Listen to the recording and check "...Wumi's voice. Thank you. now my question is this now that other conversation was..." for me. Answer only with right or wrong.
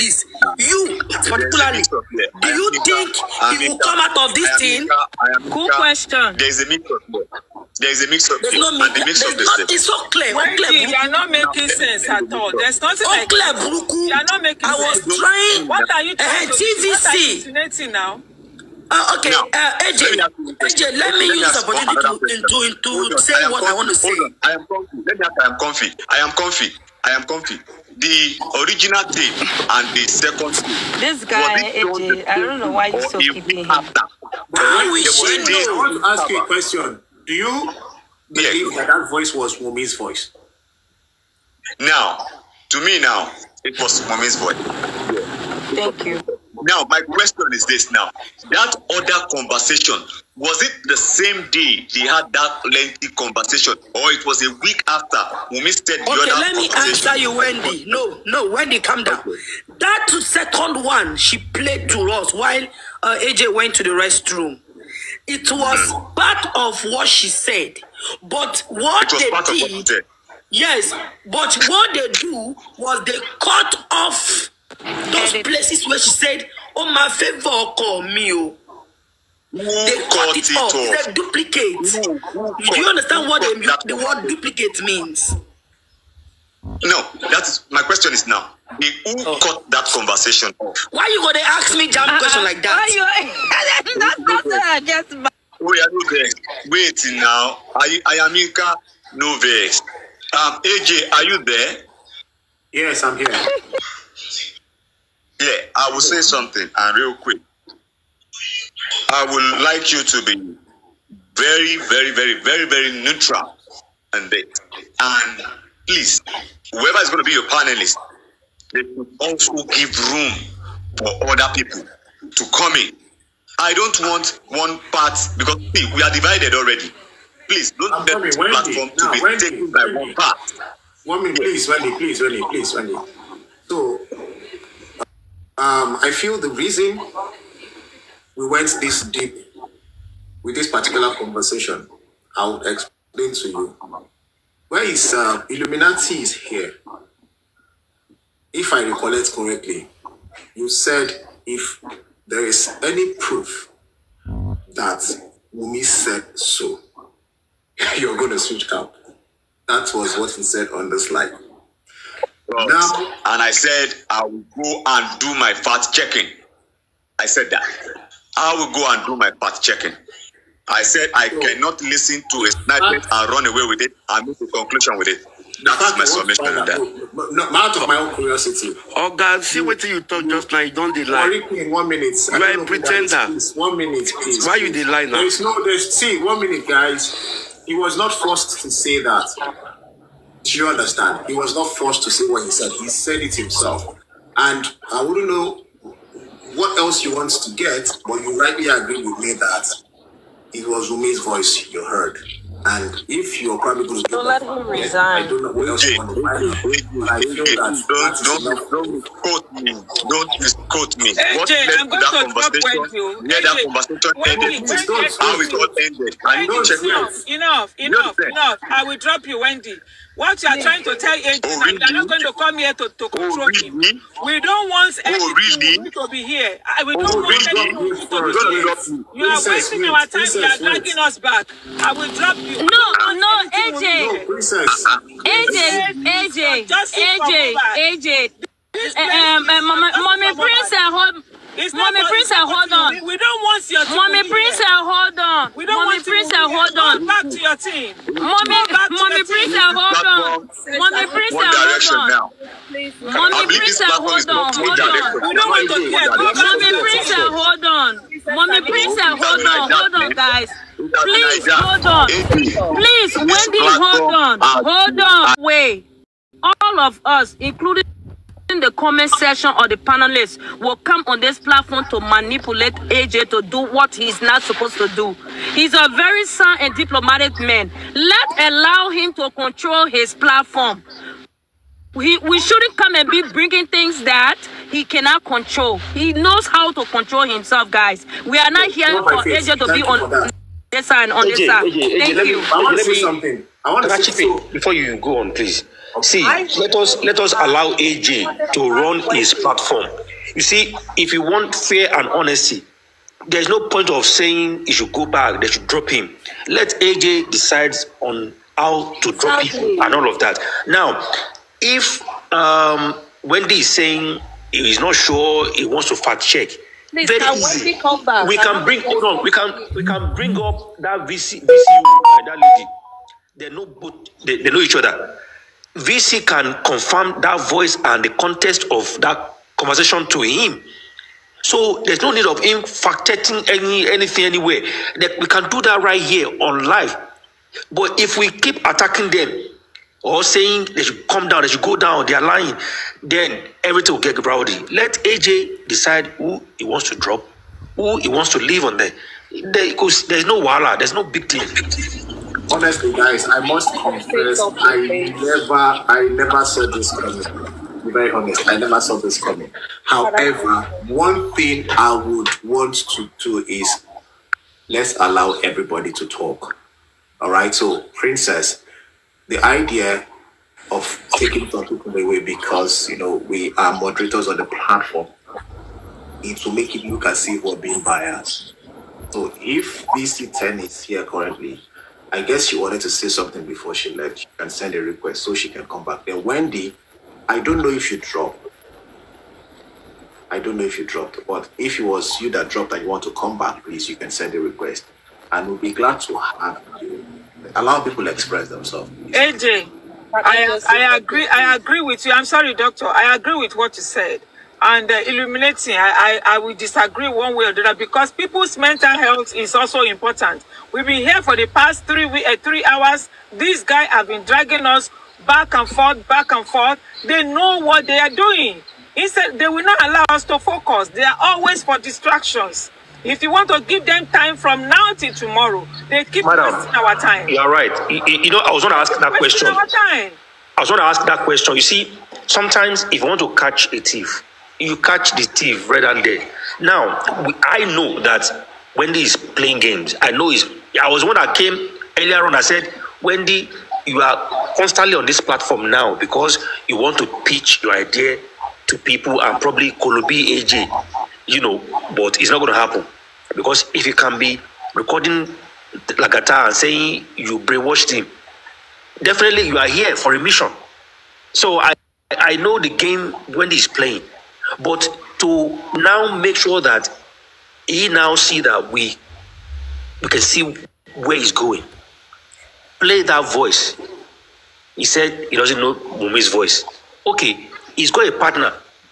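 right.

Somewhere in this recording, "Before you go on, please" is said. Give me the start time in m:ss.
4:54.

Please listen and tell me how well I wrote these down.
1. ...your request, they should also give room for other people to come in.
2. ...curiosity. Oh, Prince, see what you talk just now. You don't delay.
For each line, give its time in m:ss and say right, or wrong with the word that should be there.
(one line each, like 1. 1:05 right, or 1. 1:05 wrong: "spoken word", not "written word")
1. 1:57 wrong: "panelist", not "request"
2. 2:58 wrong: "God", not "Prince".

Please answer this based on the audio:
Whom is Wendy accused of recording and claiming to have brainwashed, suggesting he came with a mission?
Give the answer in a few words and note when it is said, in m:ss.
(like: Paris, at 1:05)
Lagata, at 7:35.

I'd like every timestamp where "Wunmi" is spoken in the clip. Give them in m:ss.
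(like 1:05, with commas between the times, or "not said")
0:55, 2:35.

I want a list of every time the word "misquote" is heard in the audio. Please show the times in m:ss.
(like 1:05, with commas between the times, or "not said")
3:30.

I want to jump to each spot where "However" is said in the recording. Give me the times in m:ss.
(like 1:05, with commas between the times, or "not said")
5:59.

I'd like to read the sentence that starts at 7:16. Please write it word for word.
Now, I know that Wendy is playing games.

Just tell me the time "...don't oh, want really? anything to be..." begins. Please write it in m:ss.
3:46.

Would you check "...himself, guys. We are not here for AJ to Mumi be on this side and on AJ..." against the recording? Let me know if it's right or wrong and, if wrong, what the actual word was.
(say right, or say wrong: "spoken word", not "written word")
wrong: "Thank", not "Mumi".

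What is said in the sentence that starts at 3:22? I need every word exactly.
And if you are probably going to don't let him resign.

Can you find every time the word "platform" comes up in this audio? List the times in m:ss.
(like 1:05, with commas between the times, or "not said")
2:08, 4:31, 4:40, 4:59, 6:14, 7:25.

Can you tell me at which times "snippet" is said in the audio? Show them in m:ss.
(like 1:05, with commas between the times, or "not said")
2:52.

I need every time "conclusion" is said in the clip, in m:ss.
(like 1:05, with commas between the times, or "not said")
2:54.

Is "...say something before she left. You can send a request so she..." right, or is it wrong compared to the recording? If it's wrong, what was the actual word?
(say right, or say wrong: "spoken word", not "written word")
right.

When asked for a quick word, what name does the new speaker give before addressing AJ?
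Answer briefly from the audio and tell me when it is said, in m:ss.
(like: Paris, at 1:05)
Inka Novex, at 1:38.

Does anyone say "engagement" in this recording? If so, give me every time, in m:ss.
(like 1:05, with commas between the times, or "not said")
not said.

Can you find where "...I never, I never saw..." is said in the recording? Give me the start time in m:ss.
5:54.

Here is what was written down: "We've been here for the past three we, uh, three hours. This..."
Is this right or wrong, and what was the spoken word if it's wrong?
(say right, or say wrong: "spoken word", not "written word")
right.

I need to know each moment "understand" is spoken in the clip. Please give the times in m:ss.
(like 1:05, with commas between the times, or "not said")
1:22, 3:10.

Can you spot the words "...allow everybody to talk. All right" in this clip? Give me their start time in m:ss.
6:04.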